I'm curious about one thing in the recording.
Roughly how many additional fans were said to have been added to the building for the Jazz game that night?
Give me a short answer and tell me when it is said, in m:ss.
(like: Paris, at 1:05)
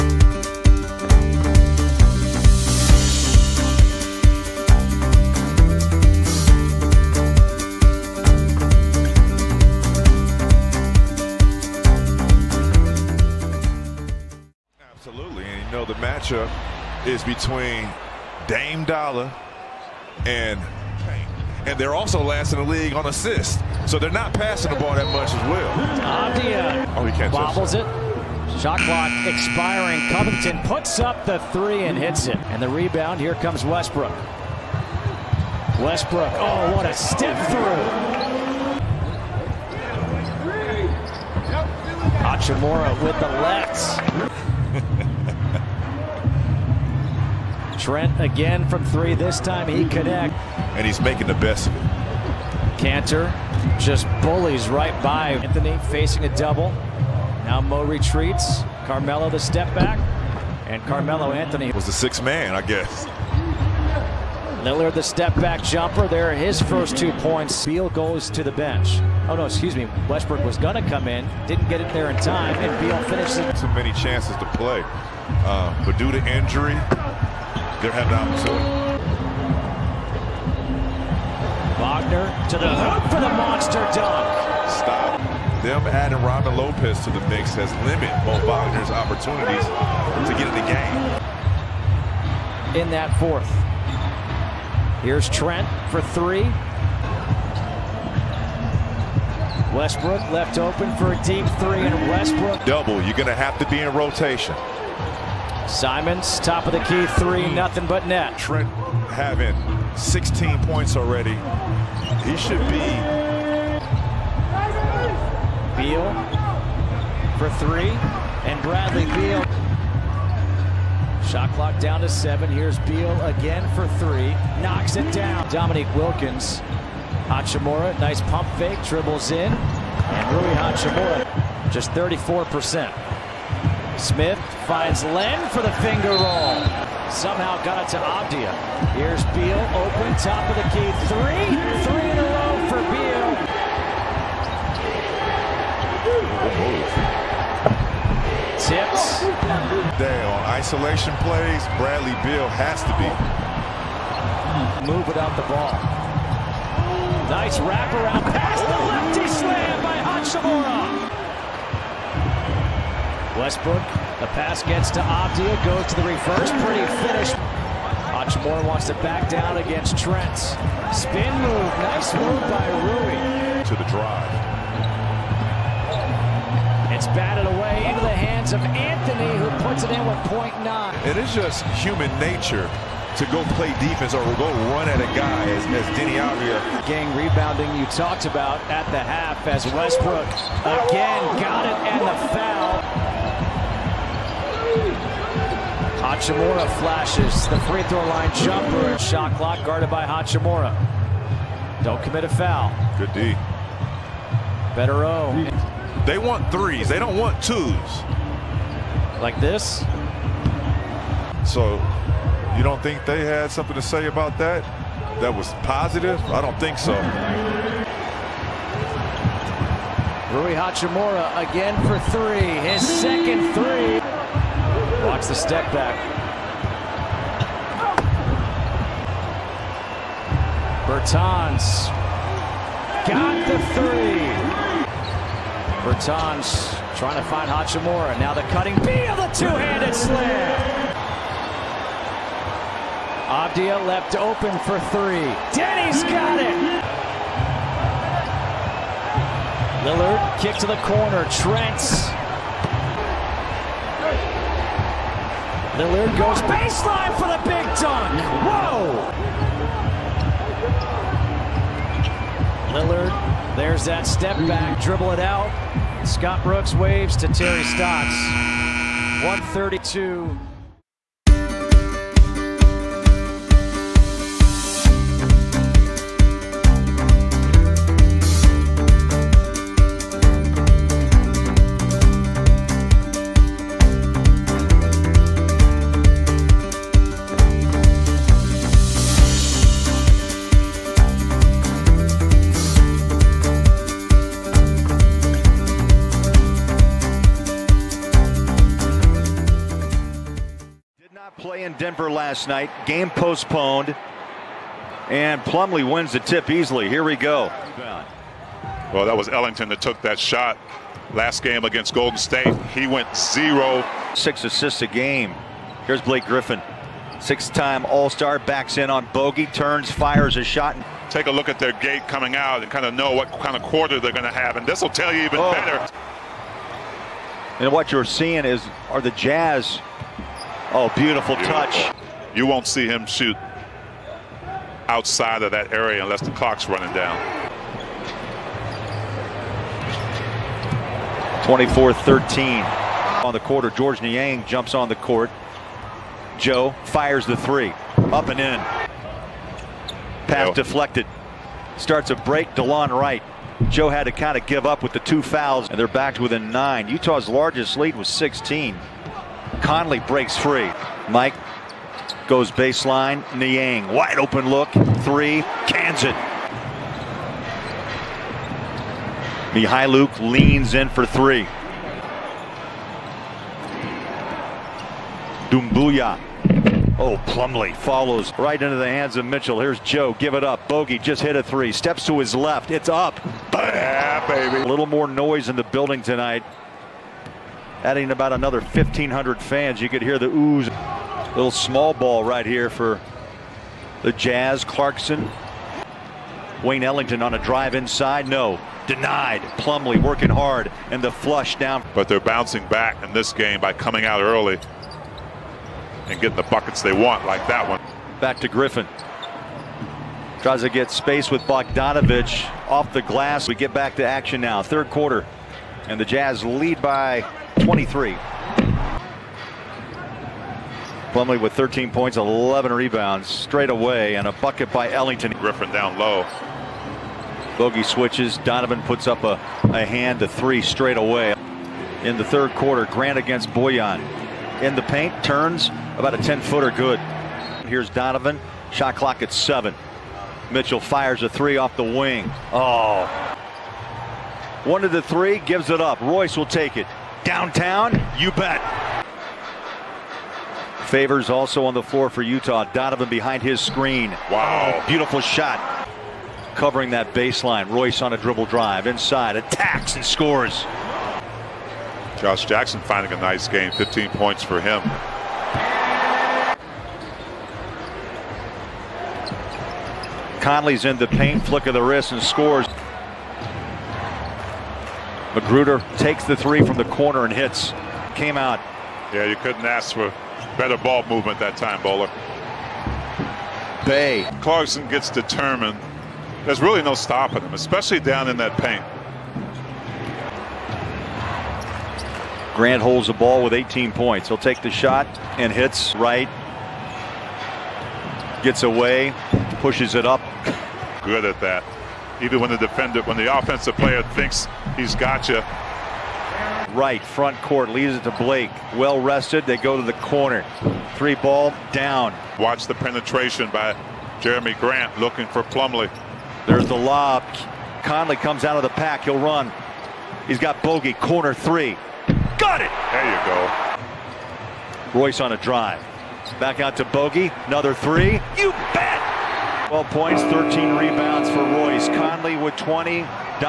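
1,500, at 6:28.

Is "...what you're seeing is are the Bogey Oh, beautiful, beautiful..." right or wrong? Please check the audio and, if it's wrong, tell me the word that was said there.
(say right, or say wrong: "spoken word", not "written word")
wrong: "Jazz", not "Bogey".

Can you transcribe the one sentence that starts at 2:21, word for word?
Three, three in a row for Beal.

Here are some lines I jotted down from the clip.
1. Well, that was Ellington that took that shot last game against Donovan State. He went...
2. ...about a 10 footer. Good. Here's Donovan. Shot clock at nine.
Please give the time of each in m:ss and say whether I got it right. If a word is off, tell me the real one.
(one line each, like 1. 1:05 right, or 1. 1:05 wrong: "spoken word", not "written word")
1. 5:08 wrong: "Golden", not "Donovan"
2. 7:15 wrong: "seven", not "nine".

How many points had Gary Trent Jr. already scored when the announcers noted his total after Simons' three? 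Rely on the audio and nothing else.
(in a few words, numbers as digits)
16.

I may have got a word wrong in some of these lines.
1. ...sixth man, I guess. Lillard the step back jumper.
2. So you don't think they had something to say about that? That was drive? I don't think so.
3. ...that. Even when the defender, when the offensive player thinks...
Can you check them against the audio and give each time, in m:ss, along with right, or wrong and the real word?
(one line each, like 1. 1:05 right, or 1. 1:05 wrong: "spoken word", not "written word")
1. 1:01 right
2. 3:31 wrong: "positive", not "drive"
3. 8:21 right.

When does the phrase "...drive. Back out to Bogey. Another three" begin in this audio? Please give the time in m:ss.
8:45.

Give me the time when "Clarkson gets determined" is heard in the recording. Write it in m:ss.
8:04.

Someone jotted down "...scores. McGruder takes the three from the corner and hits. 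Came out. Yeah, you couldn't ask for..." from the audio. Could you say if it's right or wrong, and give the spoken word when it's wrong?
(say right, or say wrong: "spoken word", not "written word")
right.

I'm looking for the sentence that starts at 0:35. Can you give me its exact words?
Westbrook, oh, what a step through.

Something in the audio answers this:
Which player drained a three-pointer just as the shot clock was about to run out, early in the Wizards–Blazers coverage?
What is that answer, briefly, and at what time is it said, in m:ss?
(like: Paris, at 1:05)
Covington, at 0:30.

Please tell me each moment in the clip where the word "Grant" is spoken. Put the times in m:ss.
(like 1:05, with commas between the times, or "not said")
7:12, 8:12, 8:34.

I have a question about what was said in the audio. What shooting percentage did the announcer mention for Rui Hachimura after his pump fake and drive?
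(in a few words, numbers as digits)
34%.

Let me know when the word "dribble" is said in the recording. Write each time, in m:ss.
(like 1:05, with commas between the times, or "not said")
2:08, 4:24, 7:38.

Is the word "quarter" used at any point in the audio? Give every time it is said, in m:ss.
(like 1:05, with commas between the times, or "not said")
5:23, 5:43, 6:54, 7:12.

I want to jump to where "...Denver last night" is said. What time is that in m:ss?
5:01.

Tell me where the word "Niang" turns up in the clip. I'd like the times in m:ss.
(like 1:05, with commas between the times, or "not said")
5:43, 6:03.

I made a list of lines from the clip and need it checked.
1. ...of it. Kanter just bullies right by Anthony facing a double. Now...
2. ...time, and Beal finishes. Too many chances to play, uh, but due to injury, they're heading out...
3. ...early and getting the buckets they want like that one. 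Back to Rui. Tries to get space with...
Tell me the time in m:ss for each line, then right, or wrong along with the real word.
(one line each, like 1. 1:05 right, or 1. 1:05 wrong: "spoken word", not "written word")
1. 0:51 right
2. 1:12 right
3. 6:44 wrong: "Griffin", not "Rui".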